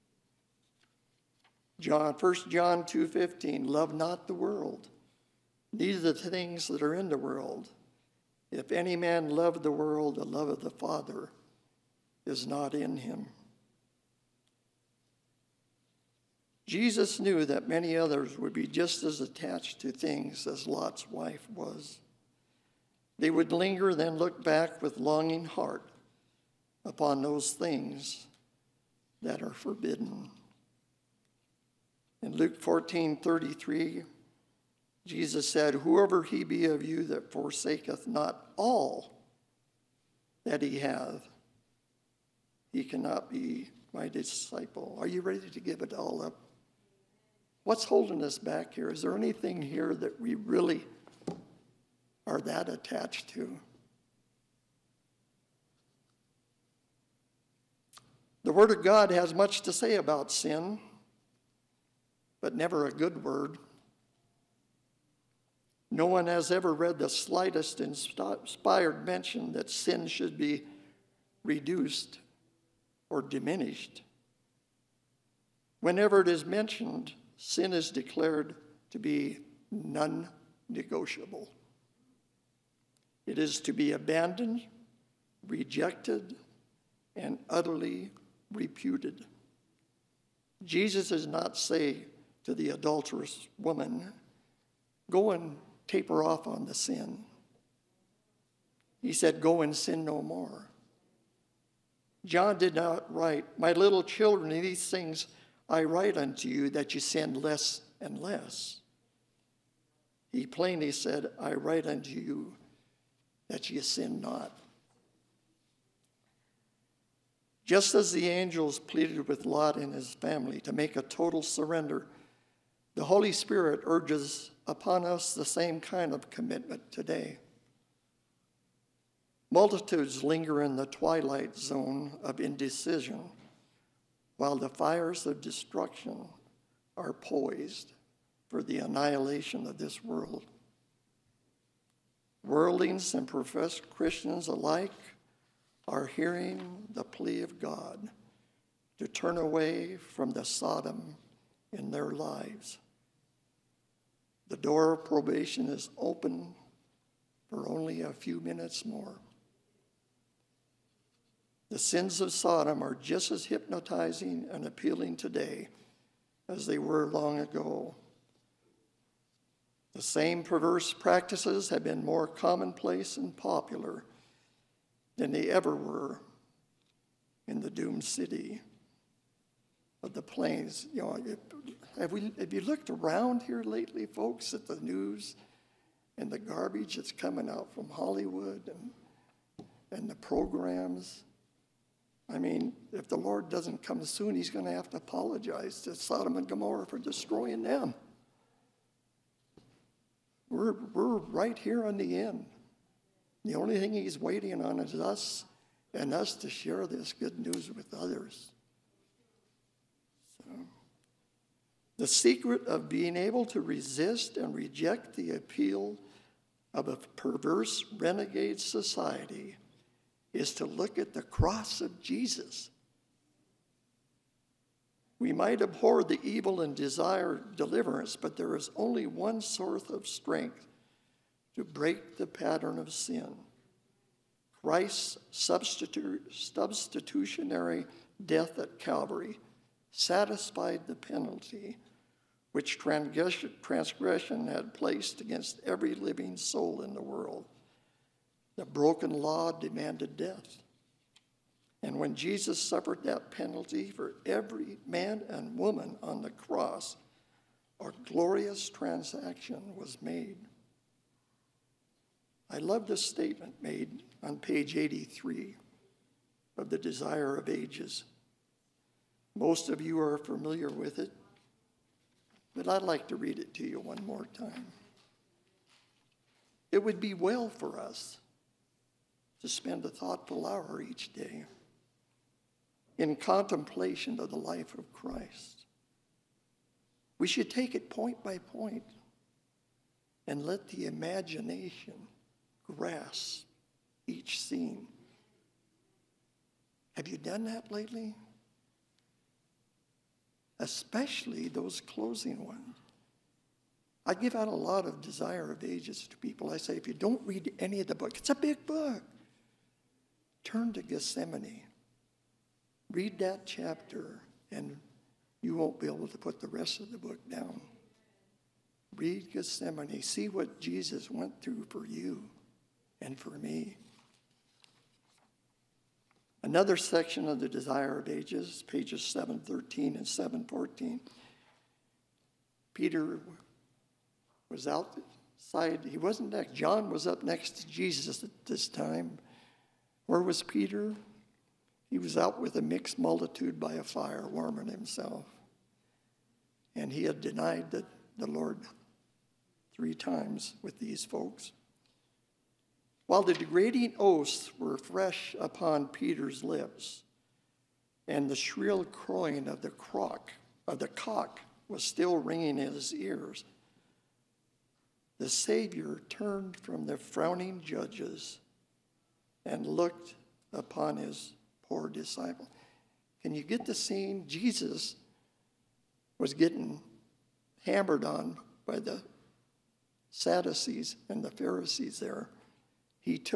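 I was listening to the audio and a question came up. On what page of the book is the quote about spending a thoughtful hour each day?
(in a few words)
83.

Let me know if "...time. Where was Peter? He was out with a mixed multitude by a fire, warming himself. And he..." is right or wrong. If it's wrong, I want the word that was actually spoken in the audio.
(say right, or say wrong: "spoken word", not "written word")
right.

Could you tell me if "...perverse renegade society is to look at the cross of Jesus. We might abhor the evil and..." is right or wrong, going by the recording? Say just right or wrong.
right.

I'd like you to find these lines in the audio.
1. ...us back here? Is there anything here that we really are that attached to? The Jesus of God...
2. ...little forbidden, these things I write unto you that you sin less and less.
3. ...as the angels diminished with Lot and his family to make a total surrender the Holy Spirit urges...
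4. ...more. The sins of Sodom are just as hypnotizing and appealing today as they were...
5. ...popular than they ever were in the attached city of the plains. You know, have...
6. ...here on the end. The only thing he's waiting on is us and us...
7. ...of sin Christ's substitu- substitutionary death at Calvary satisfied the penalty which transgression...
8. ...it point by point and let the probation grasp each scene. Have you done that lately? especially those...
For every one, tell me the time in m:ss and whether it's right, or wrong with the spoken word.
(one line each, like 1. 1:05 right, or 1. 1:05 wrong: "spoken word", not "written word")
1. 0:48 wrong: "Word", not "Jesus"
2. 1:43 wrong: "children", not "forbidden"
3. 1:57 wrong: "pleaded", not "diminished"
4. 2:38 right
5. 2:53 wrong: "doomed", not "attached"
6. 3:21 right
7. 3:52 right
8. 4:47 wrong: "imagination", not "probation".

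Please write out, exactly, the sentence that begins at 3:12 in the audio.
I mean, if the Lord doesn't come soon, he's going to have to apologize to Sodom and Gomorrah for destroying them.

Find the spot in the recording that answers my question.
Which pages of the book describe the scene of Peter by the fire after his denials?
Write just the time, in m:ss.
5:29.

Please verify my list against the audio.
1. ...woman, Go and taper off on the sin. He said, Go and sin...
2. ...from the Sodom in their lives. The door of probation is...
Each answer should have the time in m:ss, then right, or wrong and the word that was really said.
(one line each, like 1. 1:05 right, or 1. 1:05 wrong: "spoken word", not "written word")
1. 1:33 right
2. 2:29 right.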